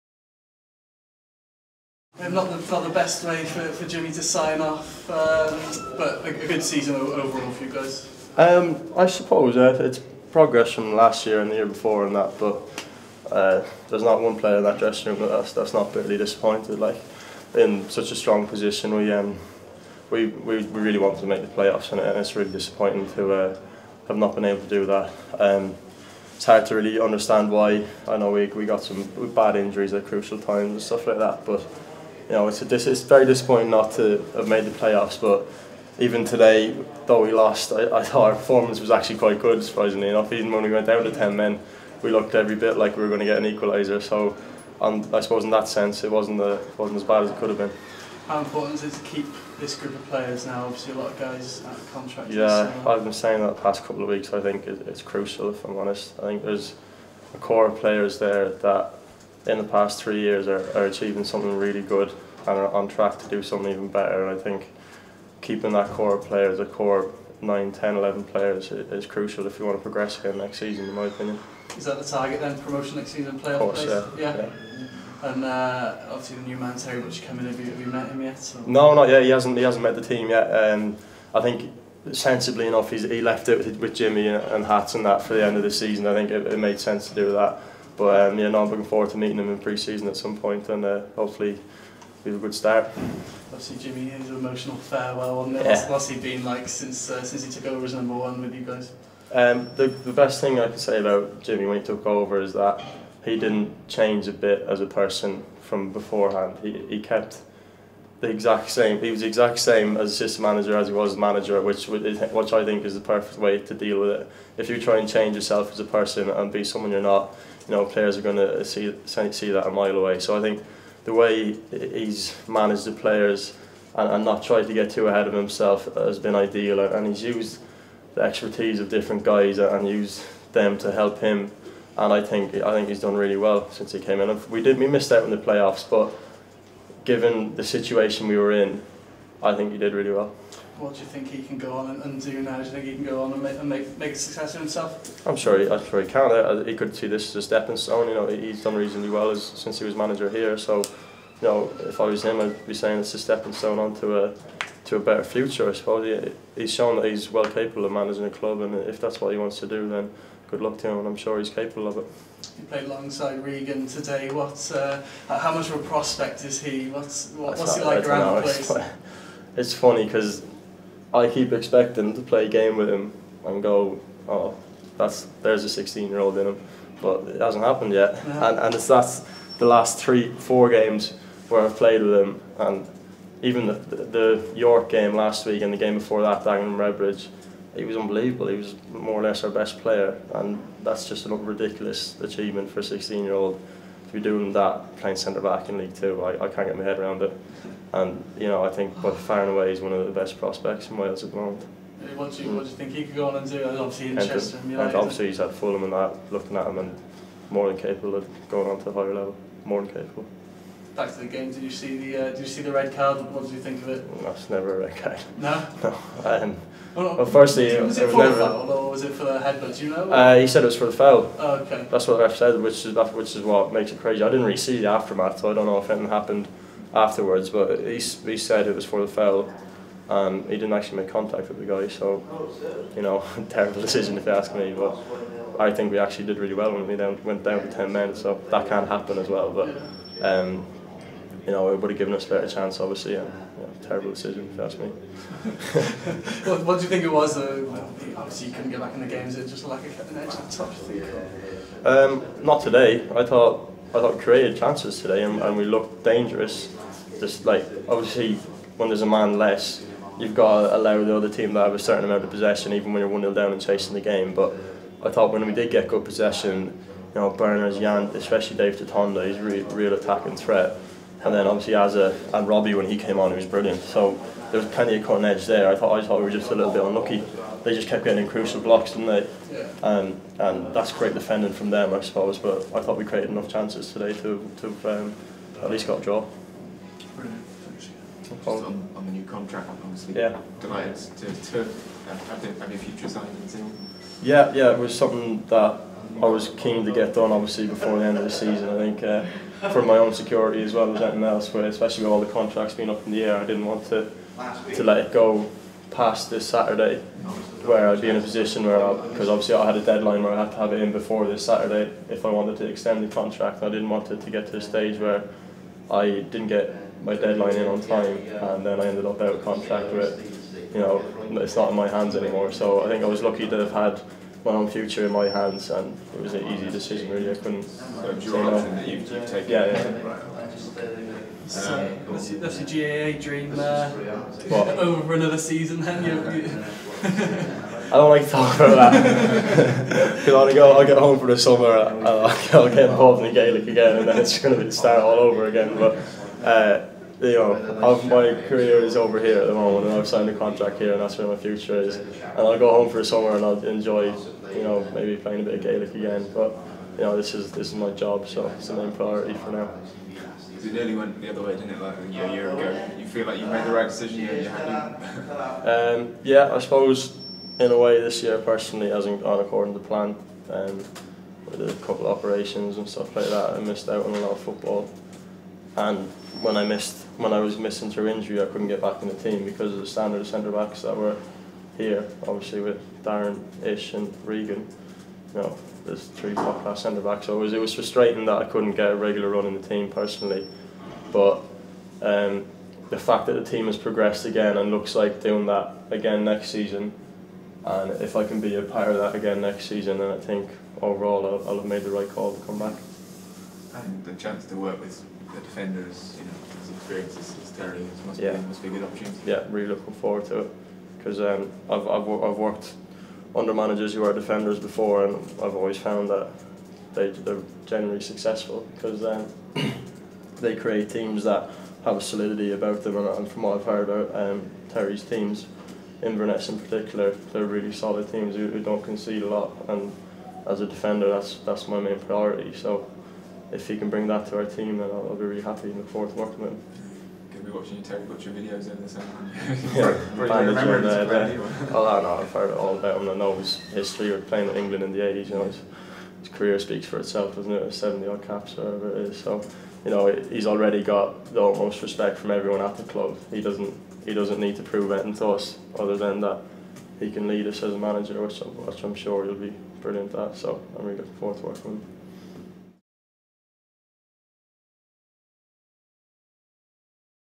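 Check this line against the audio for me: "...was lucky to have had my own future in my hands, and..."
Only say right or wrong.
right.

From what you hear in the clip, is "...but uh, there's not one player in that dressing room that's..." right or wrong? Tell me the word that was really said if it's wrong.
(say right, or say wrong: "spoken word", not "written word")
right.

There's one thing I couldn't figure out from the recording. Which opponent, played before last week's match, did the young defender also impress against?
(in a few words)
Dagenham Redbridge.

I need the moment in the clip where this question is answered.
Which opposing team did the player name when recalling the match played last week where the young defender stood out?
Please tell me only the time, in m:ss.
3:04.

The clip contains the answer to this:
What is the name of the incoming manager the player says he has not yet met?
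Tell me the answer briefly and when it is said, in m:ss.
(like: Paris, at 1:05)
Terry Rich, at 1:16.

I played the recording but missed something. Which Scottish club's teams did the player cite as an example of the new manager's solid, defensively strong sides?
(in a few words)
Inverness.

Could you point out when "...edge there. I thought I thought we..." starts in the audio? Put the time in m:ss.
4:35.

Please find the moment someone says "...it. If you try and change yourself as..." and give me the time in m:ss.
1:54.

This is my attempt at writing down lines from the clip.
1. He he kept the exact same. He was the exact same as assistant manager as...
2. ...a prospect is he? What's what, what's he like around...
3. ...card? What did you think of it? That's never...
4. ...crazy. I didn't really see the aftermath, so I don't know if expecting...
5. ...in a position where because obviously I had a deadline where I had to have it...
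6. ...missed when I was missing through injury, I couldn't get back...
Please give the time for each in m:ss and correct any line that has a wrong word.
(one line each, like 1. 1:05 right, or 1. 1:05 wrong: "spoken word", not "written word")
1. 1:46 right
2. 2:45 right
3. 3:32 right
4. 3:43 wrong: "anything", not "expecting"
5. 5:08 right
6. 6:16 right.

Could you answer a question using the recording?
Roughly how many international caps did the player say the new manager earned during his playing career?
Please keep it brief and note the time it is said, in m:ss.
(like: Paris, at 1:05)
70, at 7:27.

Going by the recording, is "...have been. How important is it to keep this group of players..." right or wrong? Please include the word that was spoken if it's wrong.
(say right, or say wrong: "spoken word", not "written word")
right.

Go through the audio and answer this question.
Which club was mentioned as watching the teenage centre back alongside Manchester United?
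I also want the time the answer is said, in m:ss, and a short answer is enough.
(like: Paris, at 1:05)
Fulham, at 3:25.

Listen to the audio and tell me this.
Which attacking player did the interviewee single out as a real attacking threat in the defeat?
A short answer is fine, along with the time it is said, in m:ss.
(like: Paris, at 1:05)
Dave Tatonda, at 4:28.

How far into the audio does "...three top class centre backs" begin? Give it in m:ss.
6:26.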